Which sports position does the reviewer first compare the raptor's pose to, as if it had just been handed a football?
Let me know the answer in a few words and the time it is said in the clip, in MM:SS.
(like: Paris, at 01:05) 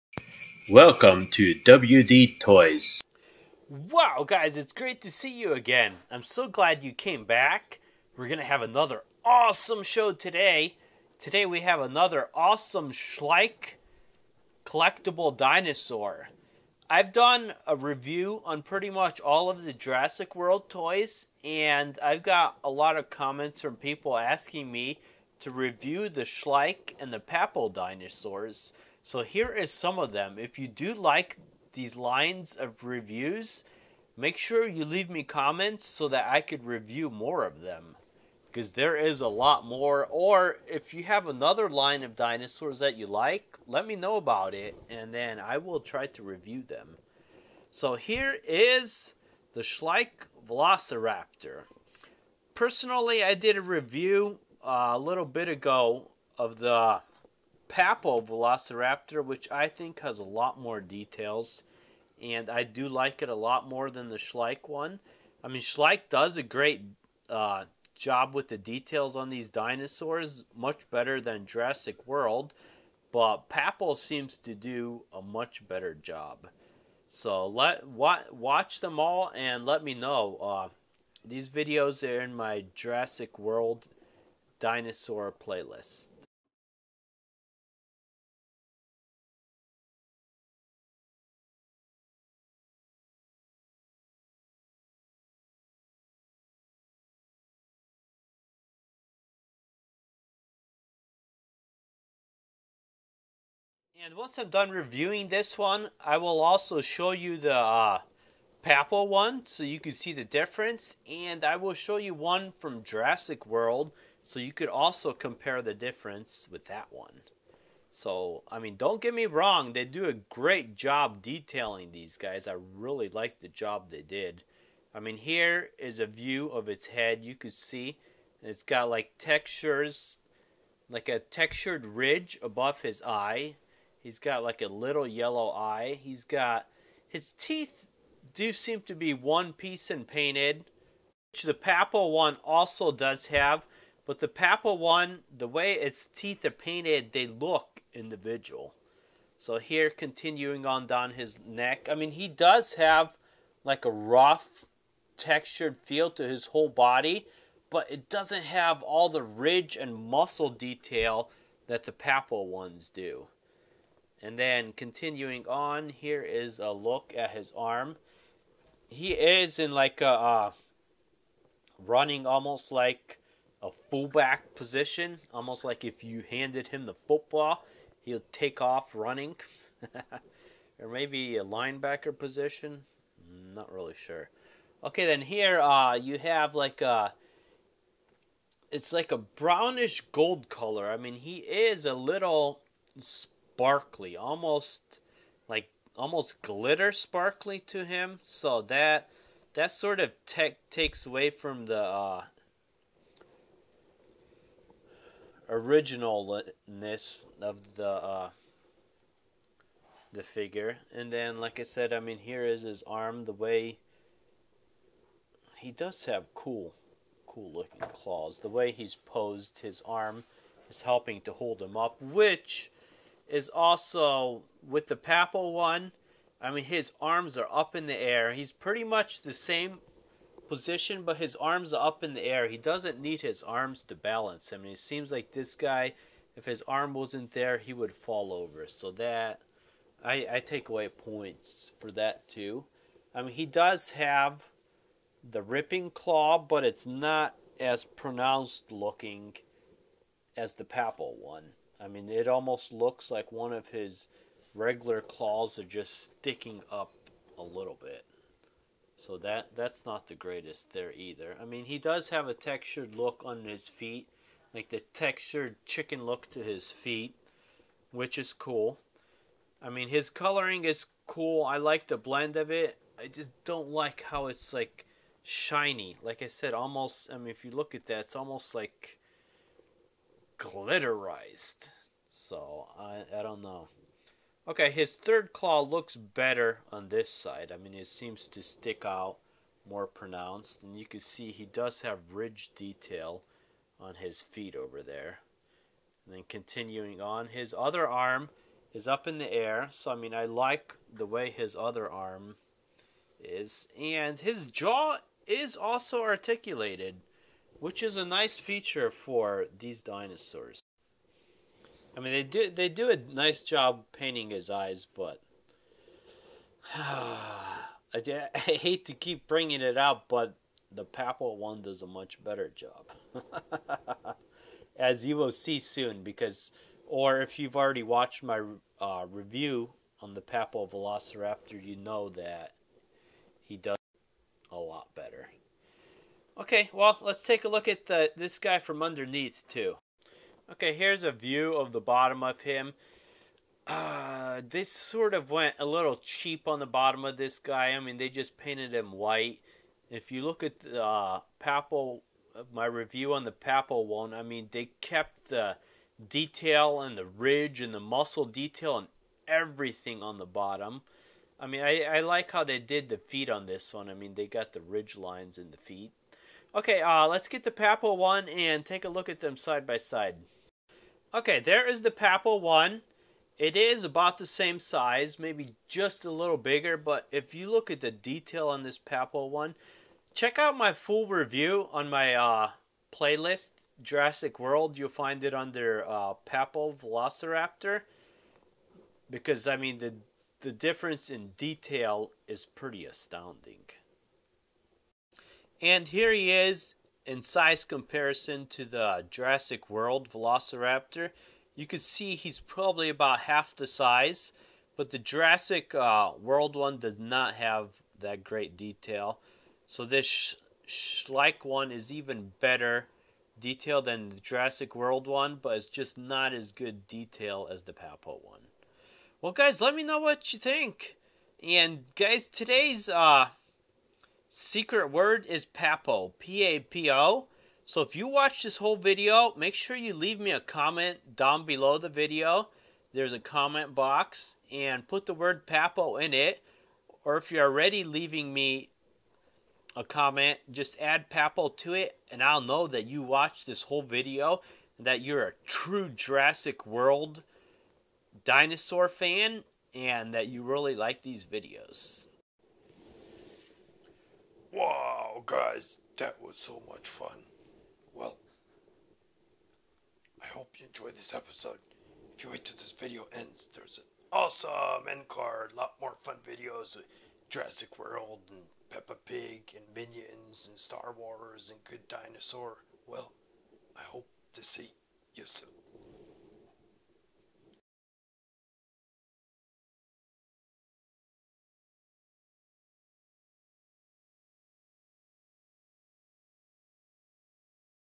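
Fullback, at 02:53.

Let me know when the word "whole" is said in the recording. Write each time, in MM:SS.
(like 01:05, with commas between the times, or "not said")
02:36, 07:08, 07:23.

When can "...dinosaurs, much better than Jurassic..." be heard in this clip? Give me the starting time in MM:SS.
01:09.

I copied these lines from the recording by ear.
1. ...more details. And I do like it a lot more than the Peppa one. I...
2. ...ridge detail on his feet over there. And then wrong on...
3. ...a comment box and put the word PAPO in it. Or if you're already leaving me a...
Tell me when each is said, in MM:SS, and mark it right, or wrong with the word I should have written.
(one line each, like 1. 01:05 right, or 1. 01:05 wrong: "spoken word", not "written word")
1. 01:00 wrong: "Schleich", not "Peppa"
2. 04:52 wrong: "continuing", not "wrong"
3. 07:13 right.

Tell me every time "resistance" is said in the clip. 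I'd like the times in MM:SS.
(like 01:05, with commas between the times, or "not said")
not said.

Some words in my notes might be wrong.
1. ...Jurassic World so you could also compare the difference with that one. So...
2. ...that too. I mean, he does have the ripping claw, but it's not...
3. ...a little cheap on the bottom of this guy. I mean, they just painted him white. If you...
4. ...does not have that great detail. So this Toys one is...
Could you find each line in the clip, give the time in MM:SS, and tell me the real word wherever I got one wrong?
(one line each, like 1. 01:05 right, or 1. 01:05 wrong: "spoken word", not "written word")
1. 01:52 right
2. 04:01 right
3. 05:45 right
4. 06:46 wrong: "Schleich", not "Toys".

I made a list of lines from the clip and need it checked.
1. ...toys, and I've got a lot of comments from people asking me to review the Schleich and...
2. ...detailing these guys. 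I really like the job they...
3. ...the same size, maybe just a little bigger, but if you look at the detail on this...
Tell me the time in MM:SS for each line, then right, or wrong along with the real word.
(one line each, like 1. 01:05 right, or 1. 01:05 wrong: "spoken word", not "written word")
1. 00:20 right
2. 02:01 right
3. 06:14 right.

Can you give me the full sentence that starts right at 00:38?
Because there is a lot more.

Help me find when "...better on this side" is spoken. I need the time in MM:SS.
04:45.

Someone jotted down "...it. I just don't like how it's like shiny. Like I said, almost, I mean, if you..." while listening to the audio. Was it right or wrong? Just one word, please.
right.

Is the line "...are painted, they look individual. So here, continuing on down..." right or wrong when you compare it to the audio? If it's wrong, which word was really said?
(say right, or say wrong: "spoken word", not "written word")
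right.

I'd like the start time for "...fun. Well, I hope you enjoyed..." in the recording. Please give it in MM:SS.
07:36.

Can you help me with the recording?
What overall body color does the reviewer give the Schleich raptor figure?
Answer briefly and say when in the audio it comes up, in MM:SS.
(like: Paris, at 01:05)
Brownish gold, at 03:09.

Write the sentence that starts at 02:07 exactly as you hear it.
You could see it's got like textures, like a textured ridge above his eye.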